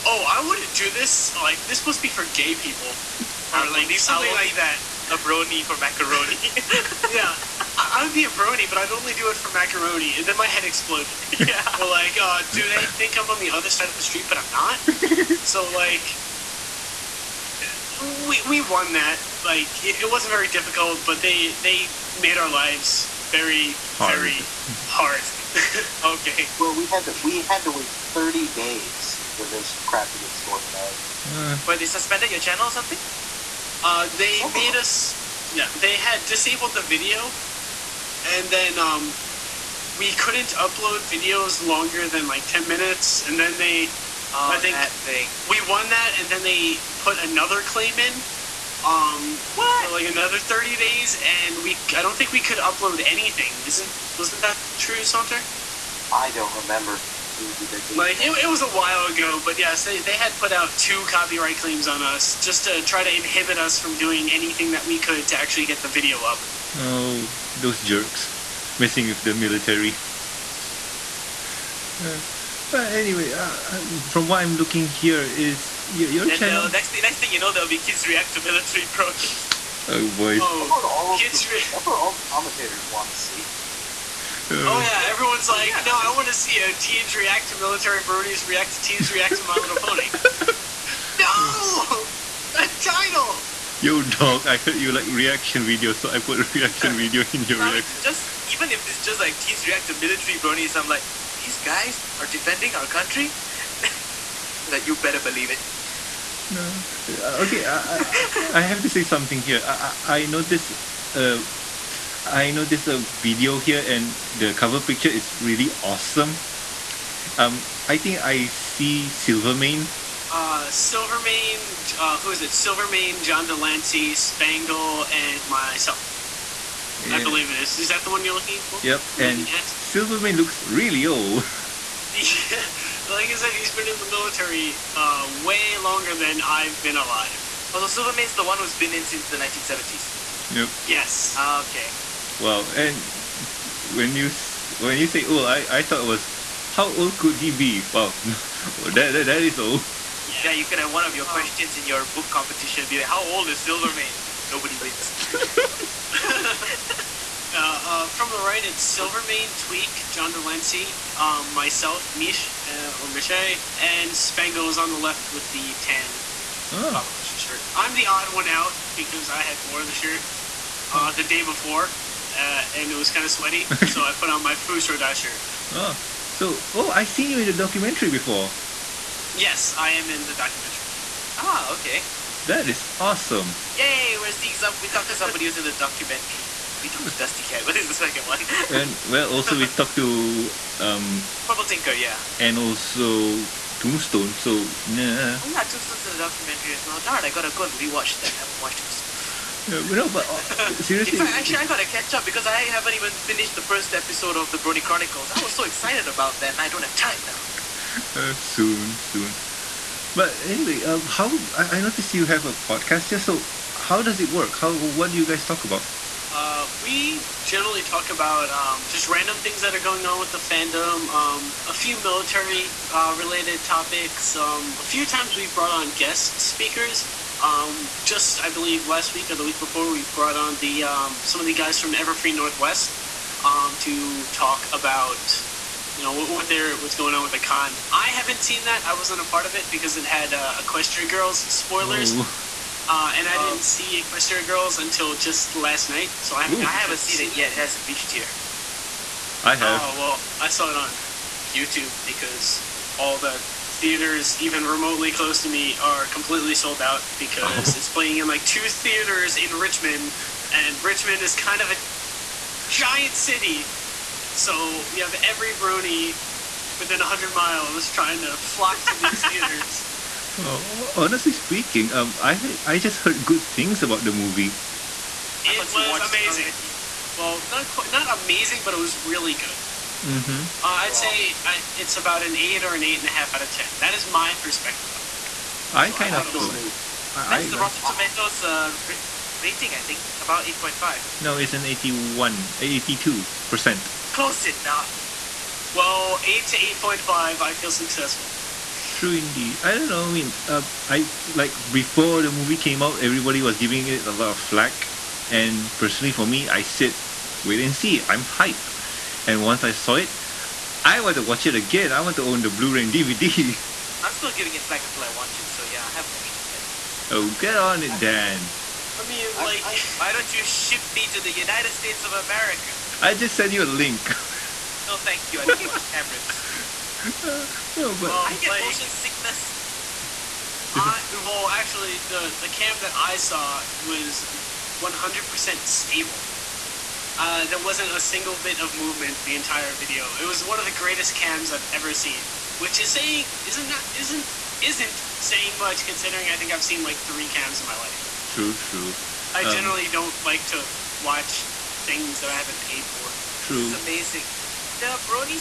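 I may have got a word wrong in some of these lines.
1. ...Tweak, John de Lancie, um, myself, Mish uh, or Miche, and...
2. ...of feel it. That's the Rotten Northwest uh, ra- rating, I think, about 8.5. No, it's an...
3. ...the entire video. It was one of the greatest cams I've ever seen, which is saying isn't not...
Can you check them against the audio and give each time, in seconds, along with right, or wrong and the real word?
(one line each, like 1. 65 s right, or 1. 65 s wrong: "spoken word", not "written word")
1. 159 s right
2. 286 s wrong: "Tomatoes", not "Northwest"
3. 339 s right.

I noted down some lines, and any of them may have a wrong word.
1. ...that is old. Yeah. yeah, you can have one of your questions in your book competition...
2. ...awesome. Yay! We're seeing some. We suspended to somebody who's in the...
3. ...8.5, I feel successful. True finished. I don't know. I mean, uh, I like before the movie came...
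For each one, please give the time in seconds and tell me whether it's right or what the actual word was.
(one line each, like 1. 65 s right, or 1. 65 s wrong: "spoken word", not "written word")
1. 149 s right
2. 182 s wrong: "talked", not "suspended"
3. 296 s wrong: "indeed", not "finished".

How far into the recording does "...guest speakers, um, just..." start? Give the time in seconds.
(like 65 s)
225 s.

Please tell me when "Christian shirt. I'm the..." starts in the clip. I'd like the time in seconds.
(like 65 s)
167 s.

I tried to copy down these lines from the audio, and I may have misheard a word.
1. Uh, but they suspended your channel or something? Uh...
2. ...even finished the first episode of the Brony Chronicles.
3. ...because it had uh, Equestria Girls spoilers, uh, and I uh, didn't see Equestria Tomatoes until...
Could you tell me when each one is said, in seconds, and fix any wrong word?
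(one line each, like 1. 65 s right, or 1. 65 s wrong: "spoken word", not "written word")
1. 31 s right
2. 202 s right
3. 239 s wrong: "Girls", not "Tomatoes".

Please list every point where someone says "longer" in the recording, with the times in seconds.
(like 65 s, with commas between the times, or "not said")
41 s, 135 s.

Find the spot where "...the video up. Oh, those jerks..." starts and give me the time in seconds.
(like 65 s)
65 s.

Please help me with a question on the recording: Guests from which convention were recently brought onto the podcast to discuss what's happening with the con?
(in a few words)
Everfree Northwest.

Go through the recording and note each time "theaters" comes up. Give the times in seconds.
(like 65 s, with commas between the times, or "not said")
253 s, 258 s, 269 s.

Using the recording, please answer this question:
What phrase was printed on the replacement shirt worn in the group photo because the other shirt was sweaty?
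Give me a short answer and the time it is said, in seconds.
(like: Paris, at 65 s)
Fus Ro Dah, at 174 s.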